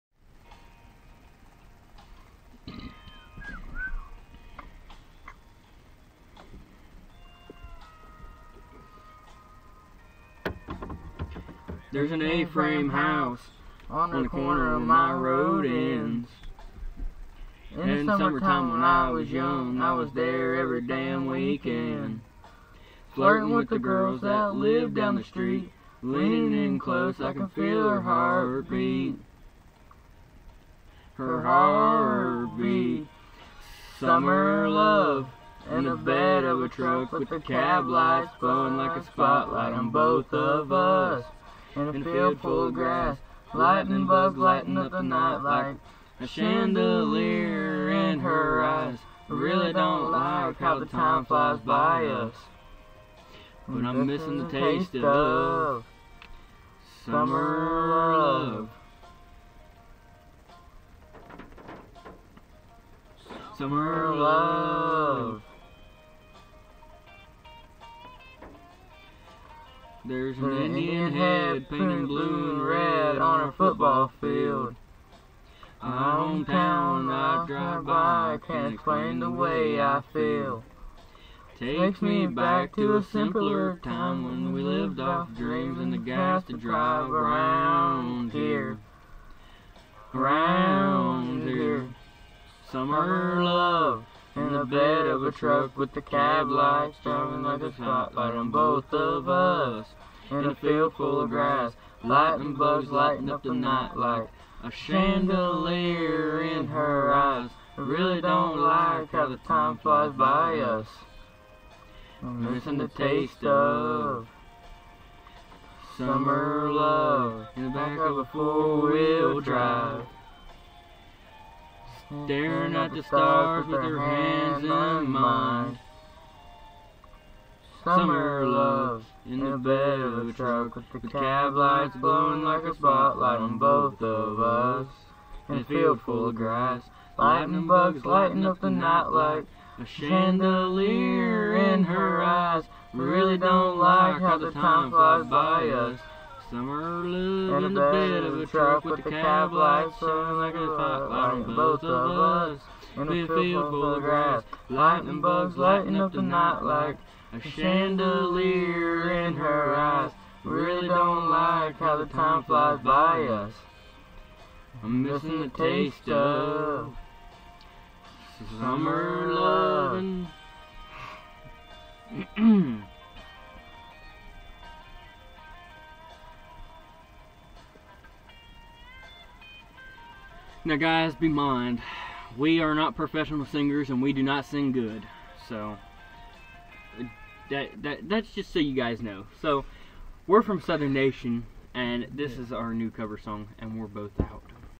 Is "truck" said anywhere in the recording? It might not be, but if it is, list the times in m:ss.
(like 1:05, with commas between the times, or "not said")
0:36, 1:35, 2:10, 2:28.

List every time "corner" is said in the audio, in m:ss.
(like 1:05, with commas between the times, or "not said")
0:14.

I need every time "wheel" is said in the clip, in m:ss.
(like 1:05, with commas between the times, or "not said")
1:58.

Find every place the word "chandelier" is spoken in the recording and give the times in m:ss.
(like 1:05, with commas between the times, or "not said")
0:46, 1:44, 2:19, 2:37.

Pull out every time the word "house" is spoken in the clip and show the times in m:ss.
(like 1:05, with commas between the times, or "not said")
0:12.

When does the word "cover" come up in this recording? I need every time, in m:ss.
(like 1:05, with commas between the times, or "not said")
3:12.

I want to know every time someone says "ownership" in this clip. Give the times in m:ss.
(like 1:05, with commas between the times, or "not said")
not said.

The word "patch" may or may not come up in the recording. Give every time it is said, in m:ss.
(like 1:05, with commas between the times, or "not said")
not said.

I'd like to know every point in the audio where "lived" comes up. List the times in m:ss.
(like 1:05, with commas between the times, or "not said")
0:24, 1:24, 2:27.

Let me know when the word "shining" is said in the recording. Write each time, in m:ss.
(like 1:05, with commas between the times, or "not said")
1:37, 2:29.